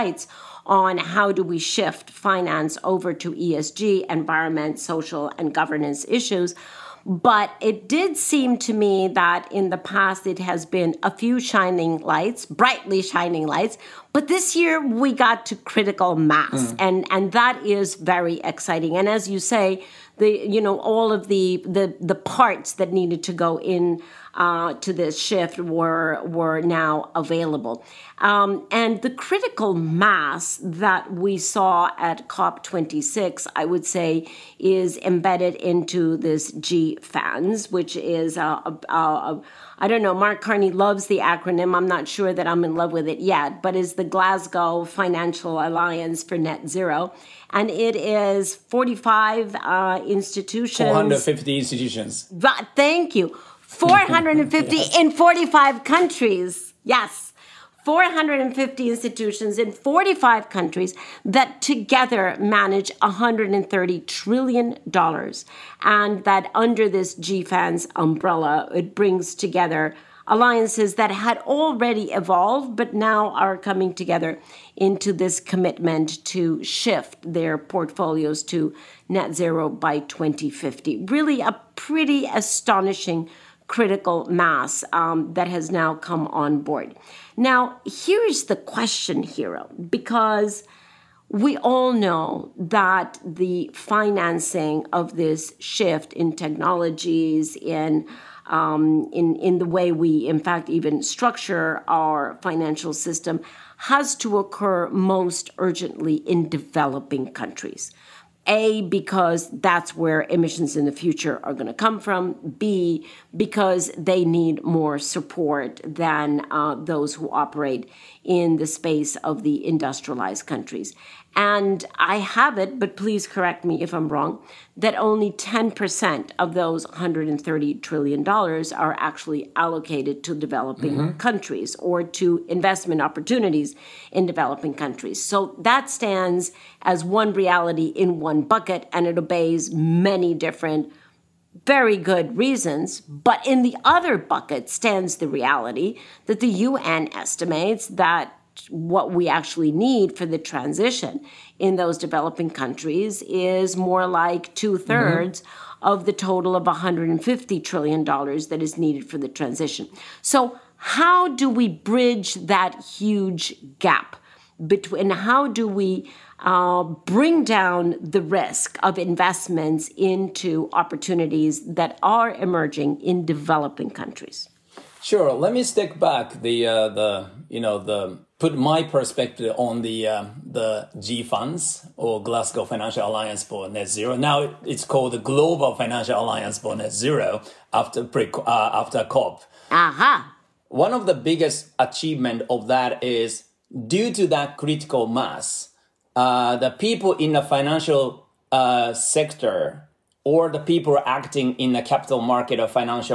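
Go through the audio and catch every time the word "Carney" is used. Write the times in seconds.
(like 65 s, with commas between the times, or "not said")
40 s.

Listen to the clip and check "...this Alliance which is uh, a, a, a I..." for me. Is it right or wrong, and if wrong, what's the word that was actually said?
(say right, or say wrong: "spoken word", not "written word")
wrong: "GFANZ", not "Alliance".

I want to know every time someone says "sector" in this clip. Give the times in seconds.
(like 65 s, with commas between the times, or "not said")
198 s.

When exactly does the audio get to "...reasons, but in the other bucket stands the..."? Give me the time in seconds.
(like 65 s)
142 s.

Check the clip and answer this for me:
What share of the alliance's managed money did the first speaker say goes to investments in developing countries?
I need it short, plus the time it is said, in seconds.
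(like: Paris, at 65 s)
10%, at 125 s.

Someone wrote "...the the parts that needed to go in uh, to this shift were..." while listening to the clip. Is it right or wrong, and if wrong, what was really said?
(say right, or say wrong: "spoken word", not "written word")
right.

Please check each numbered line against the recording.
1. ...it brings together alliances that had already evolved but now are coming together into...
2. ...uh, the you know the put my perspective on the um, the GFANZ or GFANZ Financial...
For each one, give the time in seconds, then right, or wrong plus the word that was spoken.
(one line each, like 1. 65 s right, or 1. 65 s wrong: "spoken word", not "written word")
1. 68 s right
2. 176 s wrong: "Glasgow", not "GFANZ".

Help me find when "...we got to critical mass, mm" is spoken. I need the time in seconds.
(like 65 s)
14 s.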